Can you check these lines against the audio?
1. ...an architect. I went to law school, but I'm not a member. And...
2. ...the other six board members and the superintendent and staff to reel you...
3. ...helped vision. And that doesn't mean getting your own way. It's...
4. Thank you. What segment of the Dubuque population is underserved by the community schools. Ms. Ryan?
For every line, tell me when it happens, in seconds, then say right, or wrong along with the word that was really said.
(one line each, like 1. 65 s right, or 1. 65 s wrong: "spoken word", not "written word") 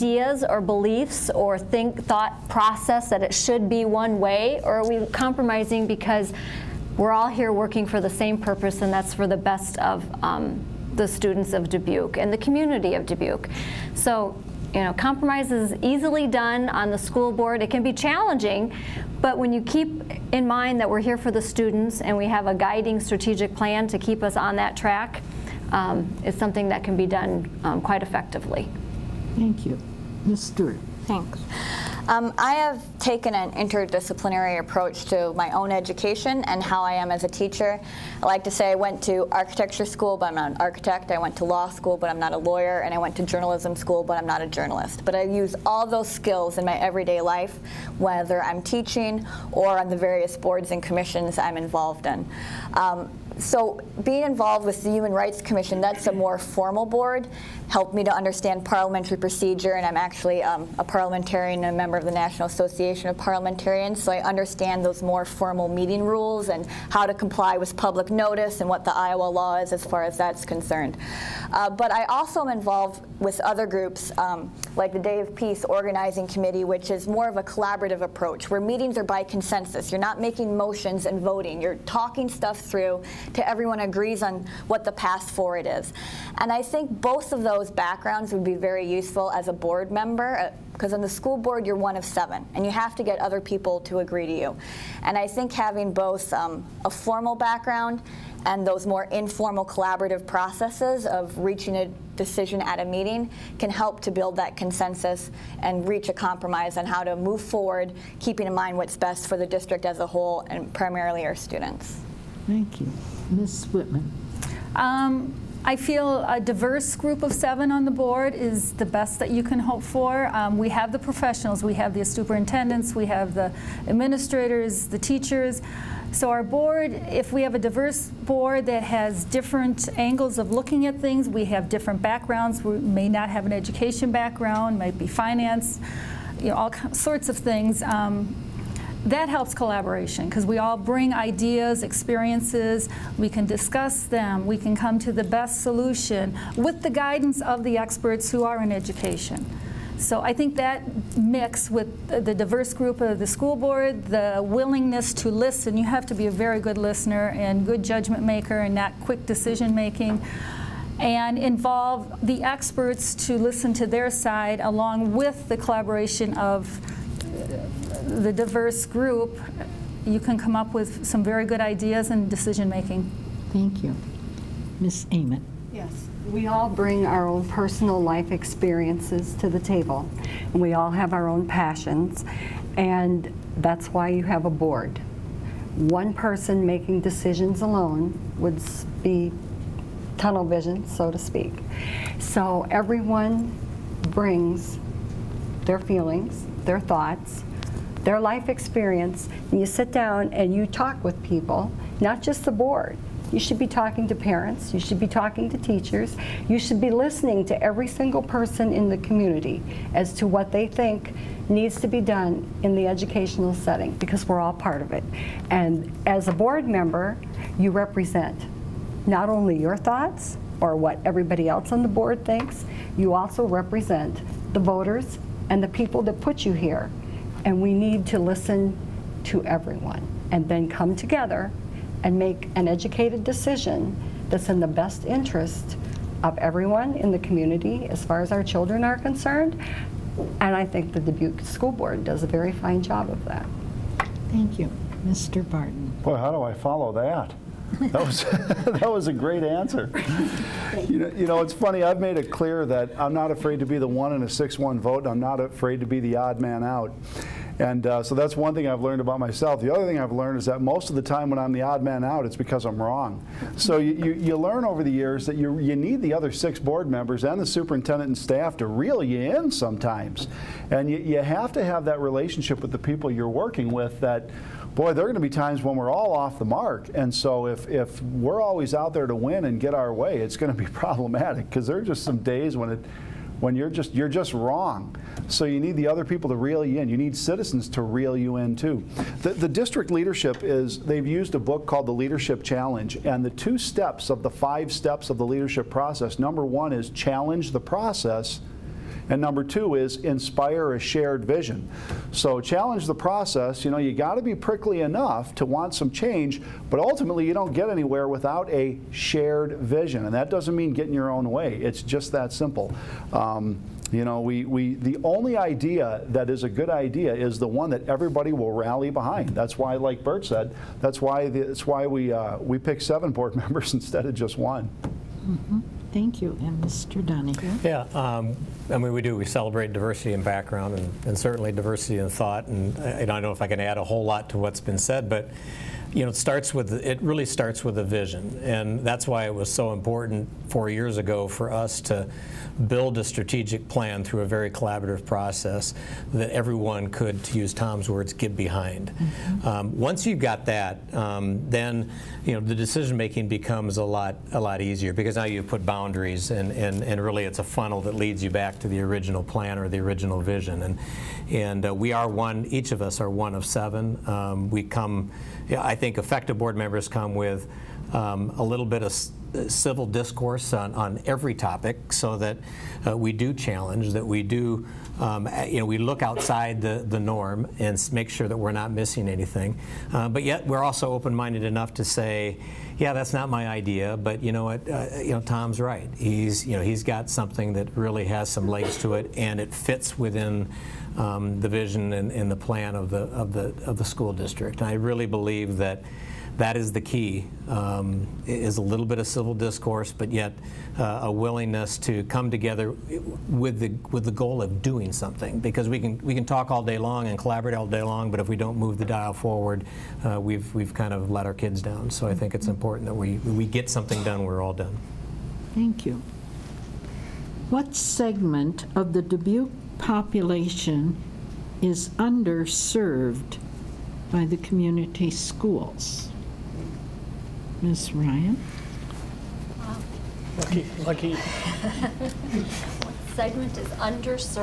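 1. 40 s wrong: "lawyer", not "member"
2. 265 s right
3. 308 s wrong: "shared", not "helped"
4. 415 s right.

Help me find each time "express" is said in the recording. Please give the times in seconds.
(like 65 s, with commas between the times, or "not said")
not said.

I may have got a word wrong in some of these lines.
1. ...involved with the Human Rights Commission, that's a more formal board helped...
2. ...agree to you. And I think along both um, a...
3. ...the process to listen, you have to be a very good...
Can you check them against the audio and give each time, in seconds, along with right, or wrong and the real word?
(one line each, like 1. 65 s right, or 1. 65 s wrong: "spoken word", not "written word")
1. 54 s right
2. 93 s wrong: "having", not "along"
3. 154 s wrong: "willingness", not "process".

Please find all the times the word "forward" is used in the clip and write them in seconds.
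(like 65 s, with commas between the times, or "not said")
85 s, 107 s, 409 s.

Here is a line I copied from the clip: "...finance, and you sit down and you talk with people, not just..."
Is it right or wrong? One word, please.
wrong.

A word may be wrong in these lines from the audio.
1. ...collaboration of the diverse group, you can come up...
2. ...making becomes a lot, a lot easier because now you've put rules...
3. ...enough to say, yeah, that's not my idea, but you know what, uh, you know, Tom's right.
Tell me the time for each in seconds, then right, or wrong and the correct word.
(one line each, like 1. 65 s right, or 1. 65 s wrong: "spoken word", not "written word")
1. 165 s right
2. 352 s wrong: "boundaries", not "rules"
3. 381 s right.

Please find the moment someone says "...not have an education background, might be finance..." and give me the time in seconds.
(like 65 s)
133 s.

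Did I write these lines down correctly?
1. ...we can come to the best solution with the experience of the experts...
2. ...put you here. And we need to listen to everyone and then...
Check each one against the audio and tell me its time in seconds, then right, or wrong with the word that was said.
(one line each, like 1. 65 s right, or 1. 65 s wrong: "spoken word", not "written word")
1. 144 s wrong: "guidance", not "experience"
2. 226 s right.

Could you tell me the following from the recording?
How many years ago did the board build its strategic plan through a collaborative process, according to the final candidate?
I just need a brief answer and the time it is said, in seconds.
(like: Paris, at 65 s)
4, at 340 s.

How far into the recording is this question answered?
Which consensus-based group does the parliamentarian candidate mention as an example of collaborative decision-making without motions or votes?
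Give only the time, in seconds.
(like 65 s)
74 s.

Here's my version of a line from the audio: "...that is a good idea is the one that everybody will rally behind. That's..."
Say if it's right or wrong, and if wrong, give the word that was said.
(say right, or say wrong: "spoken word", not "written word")
right.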